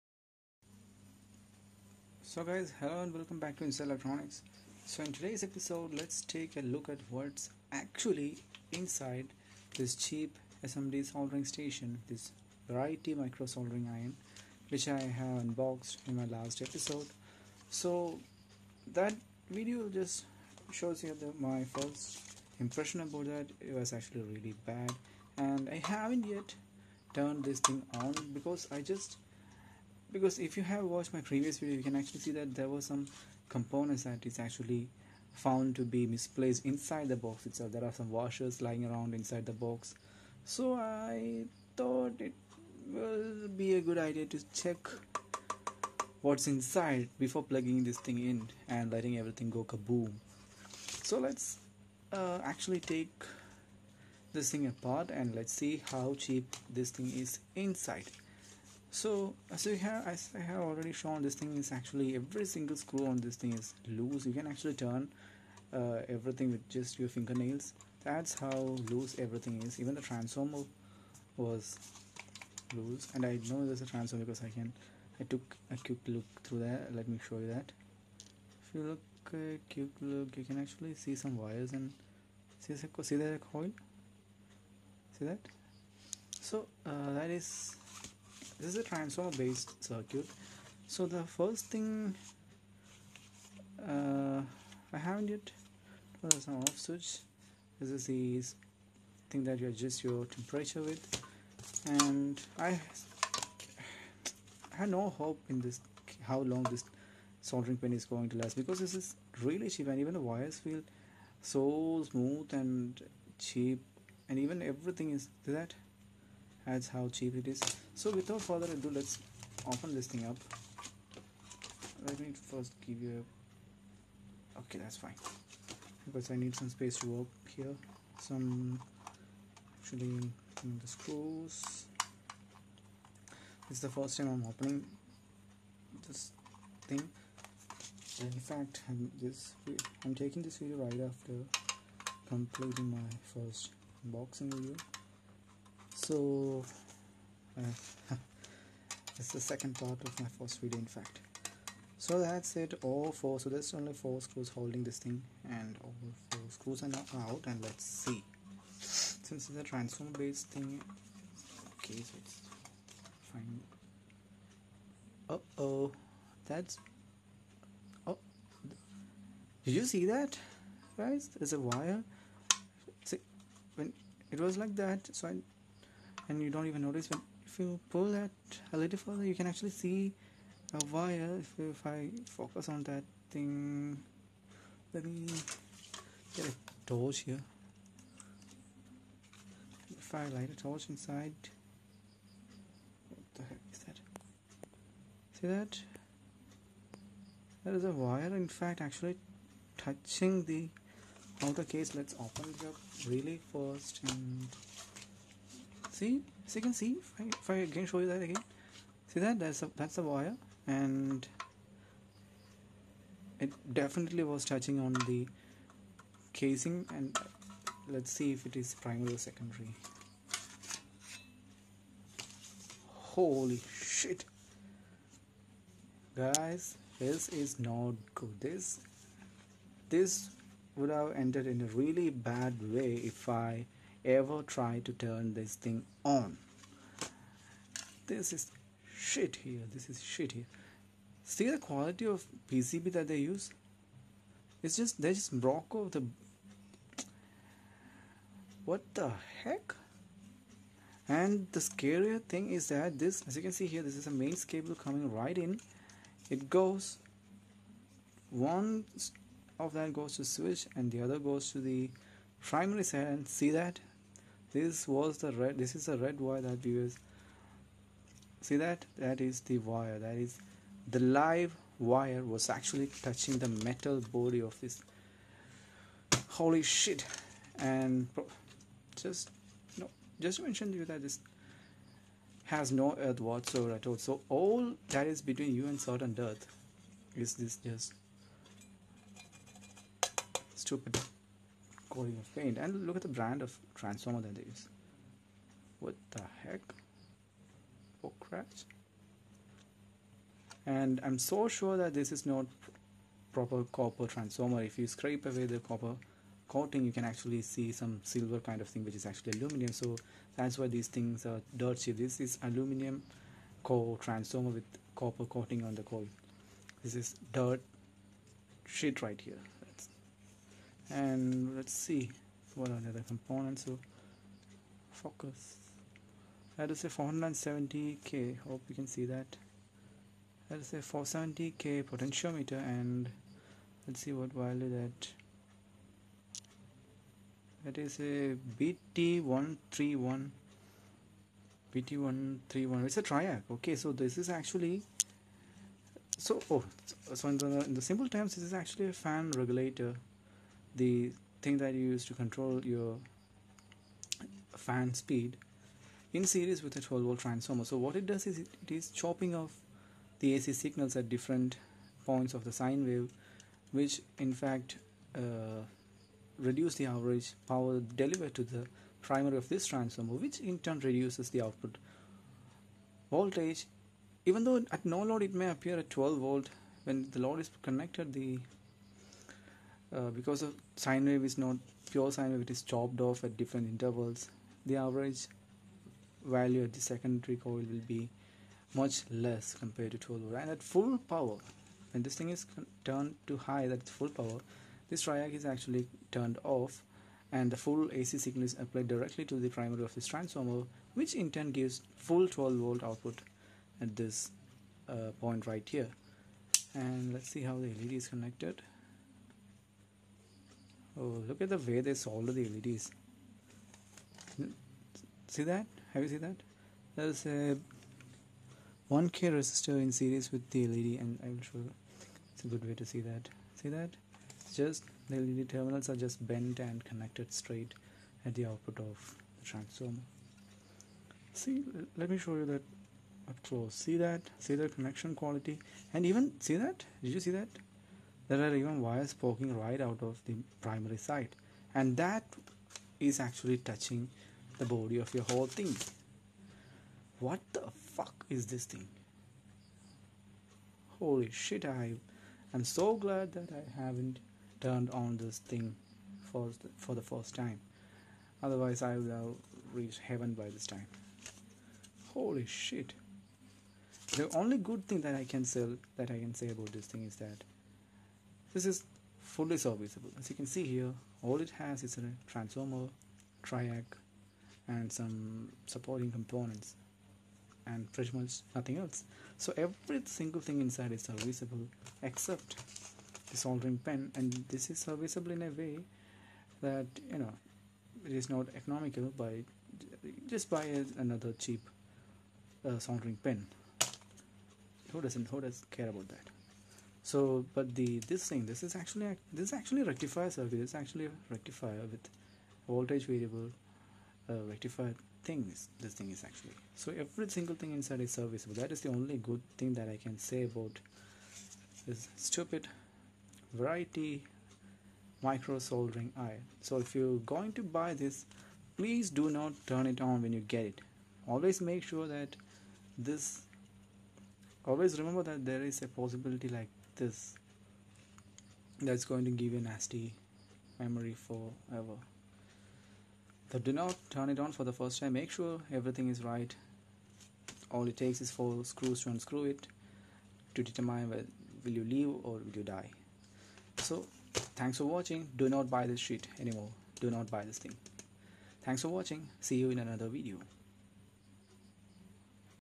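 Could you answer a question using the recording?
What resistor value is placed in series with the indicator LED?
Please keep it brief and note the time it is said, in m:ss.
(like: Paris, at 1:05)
1K, at 6:58.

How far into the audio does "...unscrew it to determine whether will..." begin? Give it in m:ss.
8:59.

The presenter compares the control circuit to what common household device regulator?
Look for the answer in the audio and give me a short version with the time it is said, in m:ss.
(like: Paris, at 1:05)
Fan regulator, at 5:48.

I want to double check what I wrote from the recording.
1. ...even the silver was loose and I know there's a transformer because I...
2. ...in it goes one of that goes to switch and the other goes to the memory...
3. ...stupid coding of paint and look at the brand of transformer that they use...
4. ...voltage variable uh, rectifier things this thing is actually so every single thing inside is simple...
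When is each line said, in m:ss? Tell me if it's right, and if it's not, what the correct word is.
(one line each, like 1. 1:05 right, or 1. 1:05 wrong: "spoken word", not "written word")
1. 1:09 wrong: "transformer", not "silver"
2. 4:15 wrong: "primary", not "memory"
3. 4:50 right
4. 8:22 wrong: "serviceable", not "simple".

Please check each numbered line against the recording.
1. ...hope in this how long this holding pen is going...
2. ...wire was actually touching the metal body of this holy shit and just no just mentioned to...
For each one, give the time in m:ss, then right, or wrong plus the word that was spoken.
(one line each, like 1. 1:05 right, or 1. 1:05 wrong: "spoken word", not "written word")
1. 1:45 wrong: "soldering", not "holding"
2. 4:31 right.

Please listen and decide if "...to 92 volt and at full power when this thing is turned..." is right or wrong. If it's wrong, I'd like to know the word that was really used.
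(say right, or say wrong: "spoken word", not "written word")
wrong: "12", not "92".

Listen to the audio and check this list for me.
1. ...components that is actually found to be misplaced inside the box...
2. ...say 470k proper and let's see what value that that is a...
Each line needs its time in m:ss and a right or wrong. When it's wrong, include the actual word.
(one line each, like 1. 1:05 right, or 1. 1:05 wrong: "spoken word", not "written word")
1. 0:33 right
2. 5:30 wrong: "potentiometer", not "proper".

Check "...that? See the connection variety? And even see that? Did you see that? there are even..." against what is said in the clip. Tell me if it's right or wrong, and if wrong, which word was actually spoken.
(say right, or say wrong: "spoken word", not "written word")
wrong: "quality", not "variety".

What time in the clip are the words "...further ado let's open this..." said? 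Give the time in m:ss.
1:58.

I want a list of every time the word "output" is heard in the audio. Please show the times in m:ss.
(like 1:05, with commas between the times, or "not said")
6:11, 6:42, 7:08.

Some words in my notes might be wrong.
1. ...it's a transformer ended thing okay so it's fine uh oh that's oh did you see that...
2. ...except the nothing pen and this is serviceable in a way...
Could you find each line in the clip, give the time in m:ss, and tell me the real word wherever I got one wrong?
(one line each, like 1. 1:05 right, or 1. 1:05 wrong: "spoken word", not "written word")
1. 2:39 wrong: "based", not "ended"
2. 8:02 wrong: "soldering", not "nothing".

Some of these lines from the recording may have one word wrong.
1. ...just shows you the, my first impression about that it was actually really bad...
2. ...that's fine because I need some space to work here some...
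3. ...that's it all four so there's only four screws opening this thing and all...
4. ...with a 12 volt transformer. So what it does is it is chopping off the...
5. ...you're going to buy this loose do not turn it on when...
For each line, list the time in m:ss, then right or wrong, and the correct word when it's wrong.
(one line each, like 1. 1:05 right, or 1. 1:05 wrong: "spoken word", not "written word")
1. 0:19 right
2. 2:04 right
3. 2:32 wrong: "holding", not "opening"
4. 5:56 right
5. 8:36 wrong: "please", not "loose".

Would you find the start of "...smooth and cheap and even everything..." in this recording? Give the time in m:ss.
1:52.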